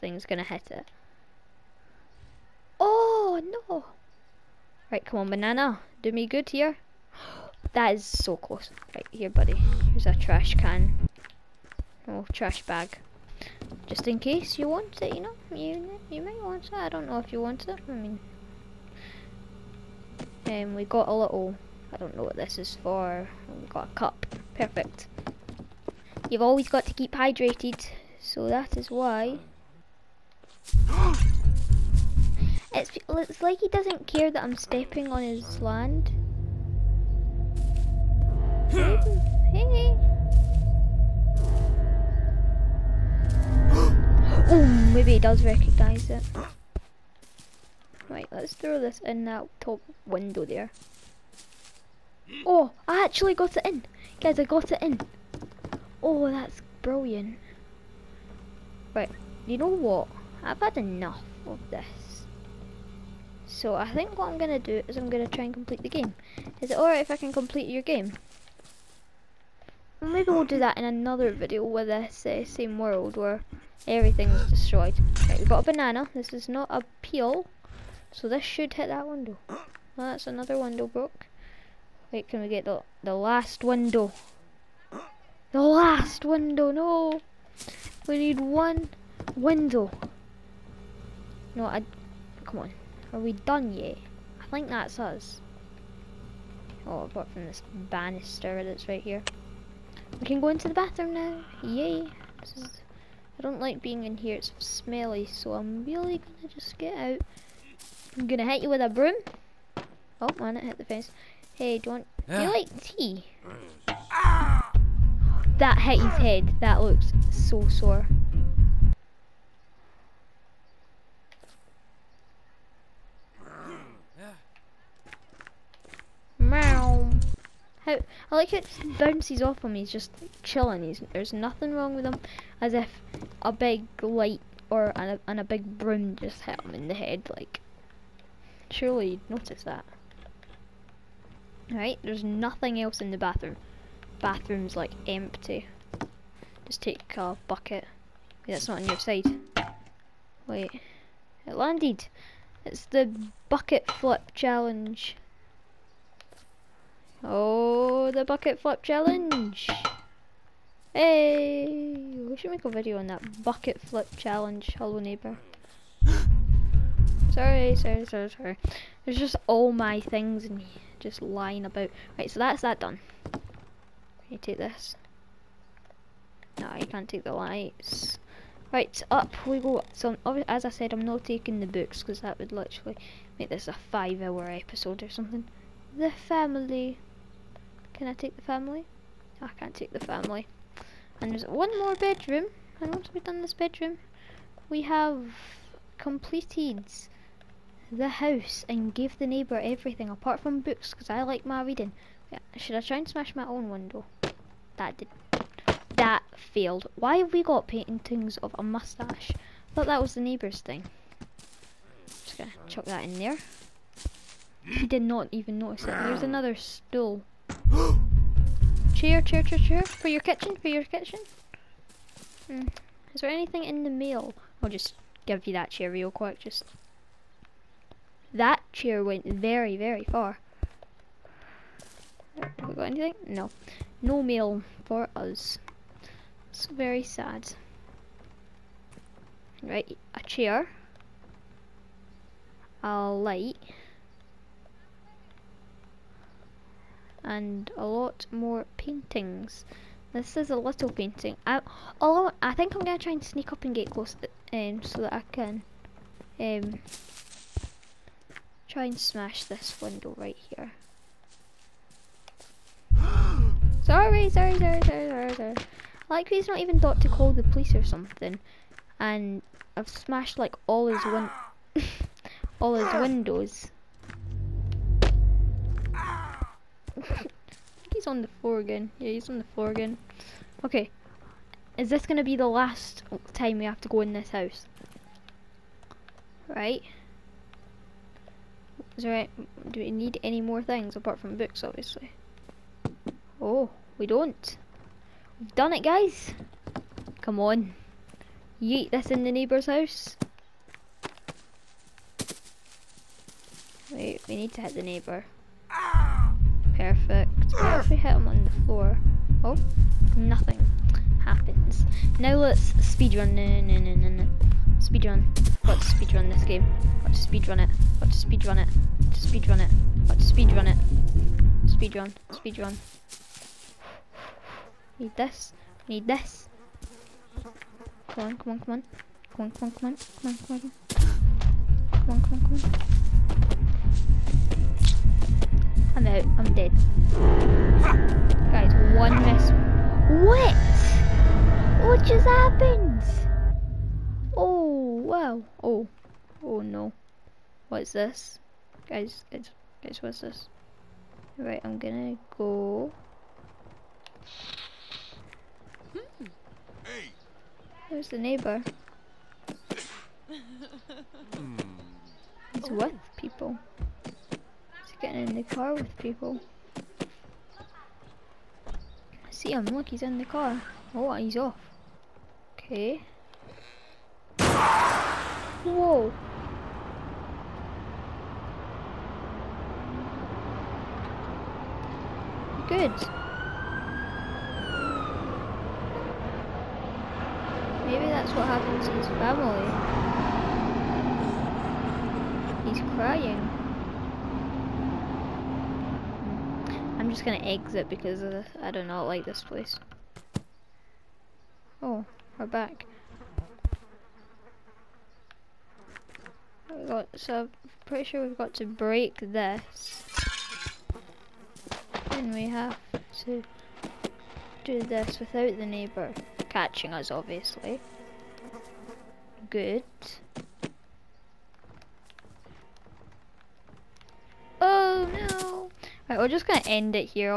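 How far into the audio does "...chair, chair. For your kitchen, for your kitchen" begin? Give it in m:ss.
3:39.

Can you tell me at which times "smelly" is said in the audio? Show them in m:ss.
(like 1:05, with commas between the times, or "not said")
1:44.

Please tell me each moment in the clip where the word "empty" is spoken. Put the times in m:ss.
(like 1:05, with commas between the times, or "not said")
2:25.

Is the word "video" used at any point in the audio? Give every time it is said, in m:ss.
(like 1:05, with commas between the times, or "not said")
1:11, 2:42.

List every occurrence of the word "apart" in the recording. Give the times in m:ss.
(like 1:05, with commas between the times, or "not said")
1:37, 3:20, 4:50.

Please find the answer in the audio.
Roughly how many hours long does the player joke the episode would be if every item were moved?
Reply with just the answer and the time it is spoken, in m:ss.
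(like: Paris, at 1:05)
5 hours, at 3:03.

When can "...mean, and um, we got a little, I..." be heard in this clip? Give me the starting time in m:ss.
0:17.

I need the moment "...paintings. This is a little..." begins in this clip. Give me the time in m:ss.
4:08.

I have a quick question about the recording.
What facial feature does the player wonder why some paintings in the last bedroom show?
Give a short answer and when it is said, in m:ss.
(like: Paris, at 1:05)
a moustache, at 3:28.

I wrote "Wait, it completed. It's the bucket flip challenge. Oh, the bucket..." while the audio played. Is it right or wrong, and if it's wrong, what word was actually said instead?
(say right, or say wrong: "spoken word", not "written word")
wrong: "landed", not "completed".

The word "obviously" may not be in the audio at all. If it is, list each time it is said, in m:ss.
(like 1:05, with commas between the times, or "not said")
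4:51, 6:57.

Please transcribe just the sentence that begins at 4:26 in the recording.
Like he's not even thought to call the police or something.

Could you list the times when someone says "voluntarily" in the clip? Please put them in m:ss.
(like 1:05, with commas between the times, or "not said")
not said.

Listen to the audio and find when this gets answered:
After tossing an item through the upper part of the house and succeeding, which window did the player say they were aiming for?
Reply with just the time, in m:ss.
0:49.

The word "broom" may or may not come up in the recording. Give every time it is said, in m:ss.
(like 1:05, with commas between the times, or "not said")
1:48, 2:15.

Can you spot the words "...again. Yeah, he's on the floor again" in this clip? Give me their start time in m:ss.
4:38.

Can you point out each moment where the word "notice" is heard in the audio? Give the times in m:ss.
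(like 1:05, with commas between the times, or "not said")
2:19, 3:35.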